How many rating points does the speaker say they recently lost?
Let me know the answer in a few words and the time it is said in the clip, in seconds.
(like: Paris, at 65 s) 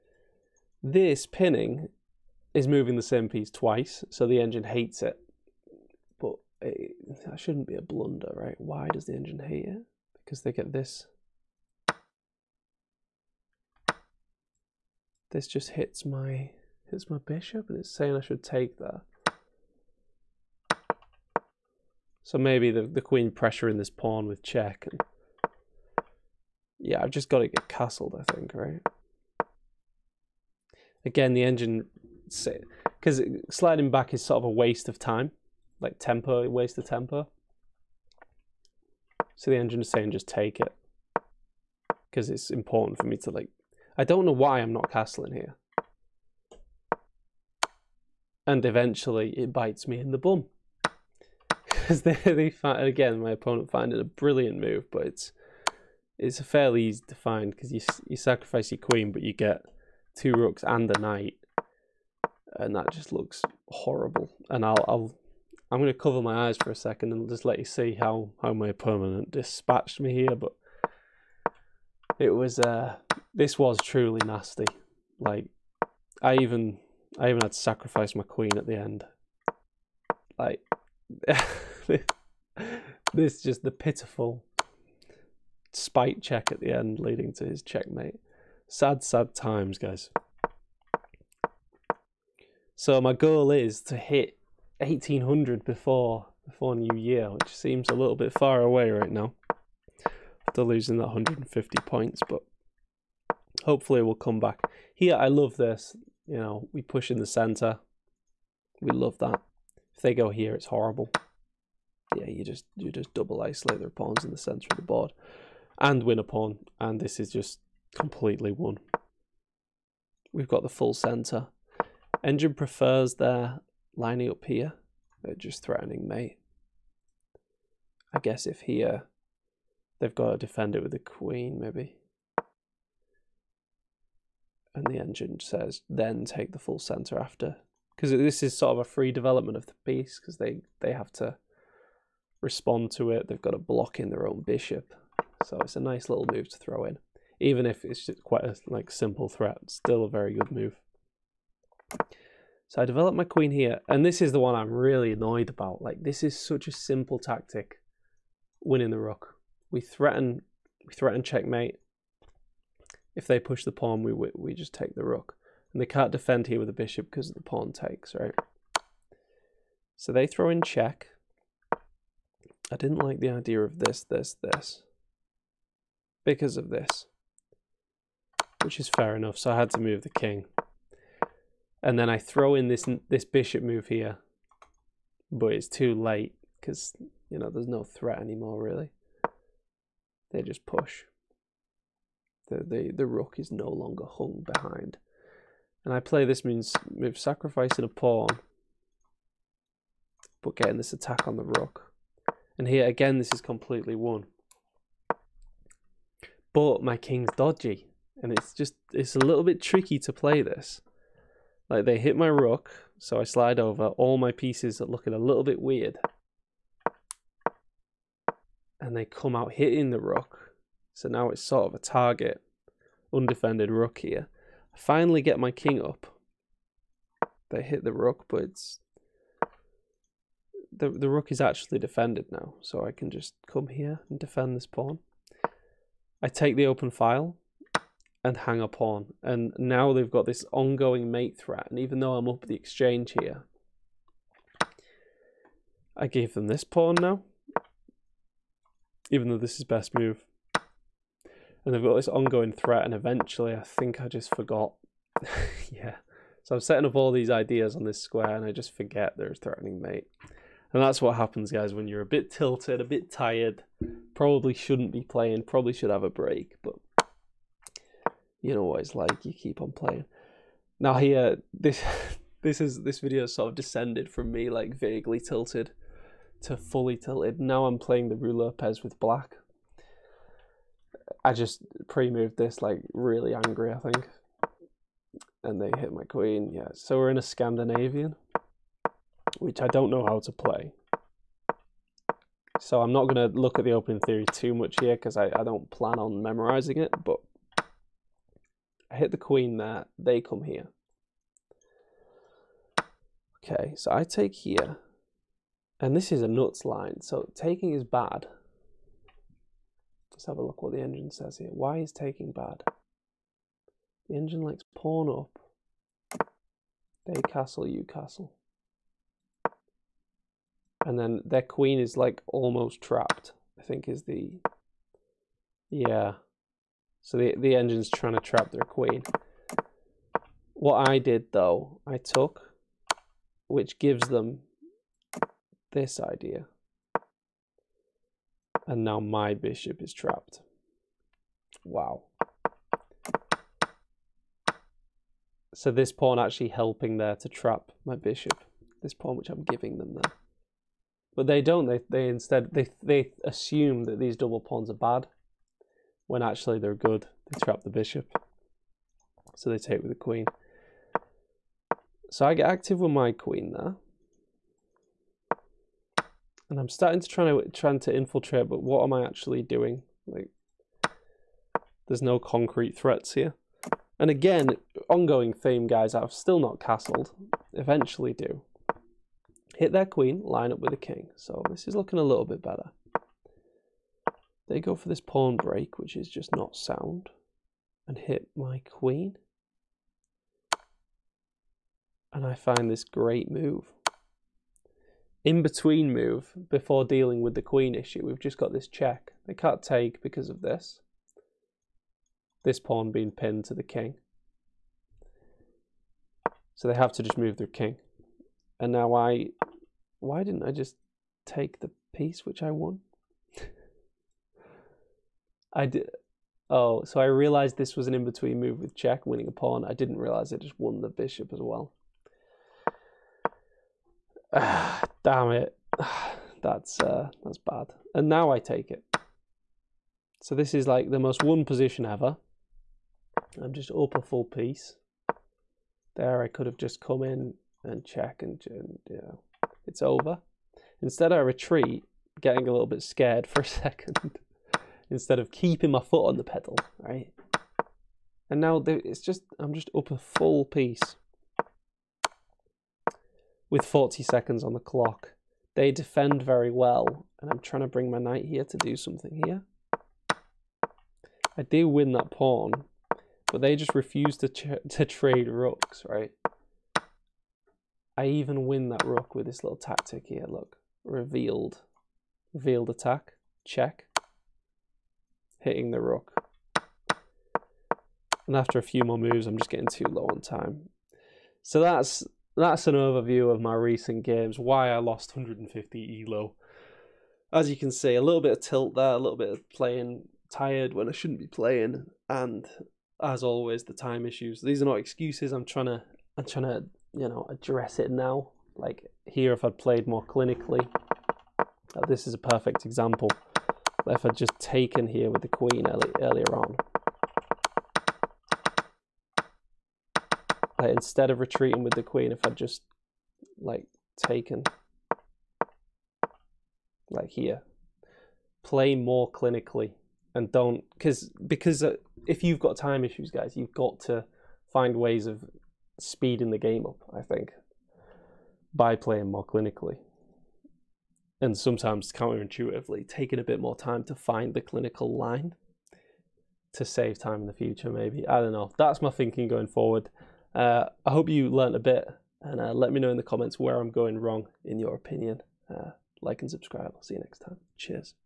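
150, at 101 s.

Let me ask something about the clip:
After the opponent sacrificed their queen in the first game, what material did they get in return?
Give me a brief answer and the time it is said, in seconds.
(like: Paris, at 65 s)
Two rooks and a knight, at 60 s.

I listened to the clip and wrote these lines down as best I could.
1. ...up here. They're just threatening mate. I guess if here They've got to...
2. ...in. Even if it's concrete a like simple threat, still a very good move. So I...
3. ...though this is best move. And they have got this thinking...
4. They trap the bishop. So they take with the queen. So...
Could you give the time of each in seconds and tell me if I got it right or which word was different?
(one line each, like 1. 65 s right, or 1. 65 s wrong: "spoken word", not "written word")
1. 124 s right
2. 146 s wrong: "quite", not "concrete"
3. 249 s wrong: "ongoing", not "thinking"
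4. 357 s right.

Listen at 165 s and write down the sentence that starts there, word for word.
And they can't defend here with the bishop because the pawn takes, right?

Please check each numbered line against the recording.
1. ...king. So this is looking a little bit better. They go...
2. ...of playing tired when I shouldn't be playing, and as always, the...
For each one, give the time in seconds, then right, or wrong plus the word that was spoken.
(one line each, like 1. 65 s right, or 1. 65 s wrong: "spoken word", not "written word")
1. 380 s right
2. 489 s right.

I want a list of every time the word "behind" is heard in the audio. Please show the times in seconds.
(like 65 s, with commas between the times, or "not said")
194 s.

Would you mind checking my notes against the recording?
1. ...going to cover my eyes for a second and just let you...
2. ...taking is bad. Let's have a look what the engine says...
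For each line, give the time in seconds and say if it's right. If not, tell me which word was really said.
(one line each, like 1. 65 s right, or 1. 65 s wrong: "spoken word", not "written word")
1. 65 s right
2. 307 s right.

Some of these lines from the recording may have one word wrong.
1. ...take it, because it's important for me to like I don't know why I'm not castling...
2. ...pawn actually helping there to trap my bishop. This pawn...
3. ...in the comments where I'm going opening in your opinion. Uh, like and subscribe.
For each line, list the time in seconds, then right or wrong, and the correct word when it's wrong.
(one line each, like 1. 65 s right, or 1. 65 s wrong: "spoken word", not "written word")
1. 40 s right
2. 345 s right
3. 542 s wrong: "wrong", not "opening".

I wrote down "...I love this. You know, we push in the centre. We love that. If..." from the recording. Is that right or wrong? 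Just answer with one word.
right.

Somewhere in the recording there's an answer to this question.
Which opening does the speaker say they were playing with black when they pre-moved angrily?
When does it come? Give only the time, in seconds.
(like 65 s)
278 s.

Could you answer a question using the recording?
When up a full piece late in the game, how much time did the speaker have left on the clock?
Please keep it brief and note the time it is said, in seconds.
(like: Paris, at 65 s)
40 seconds, at 453 s.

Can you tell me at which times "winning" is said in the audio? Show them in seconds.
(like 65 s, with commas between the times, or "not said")
158 s, 419 s.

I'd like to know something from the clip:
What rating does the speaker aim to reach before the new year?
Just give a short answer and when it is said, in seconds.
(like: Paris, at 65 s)
1800, at 94 s.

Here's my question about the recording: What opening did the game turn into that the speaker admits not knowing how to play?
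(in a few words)
Scandinavian.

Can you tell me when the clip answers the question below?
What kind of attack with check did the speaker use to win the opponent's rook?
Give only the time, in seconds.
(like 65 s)
472 s.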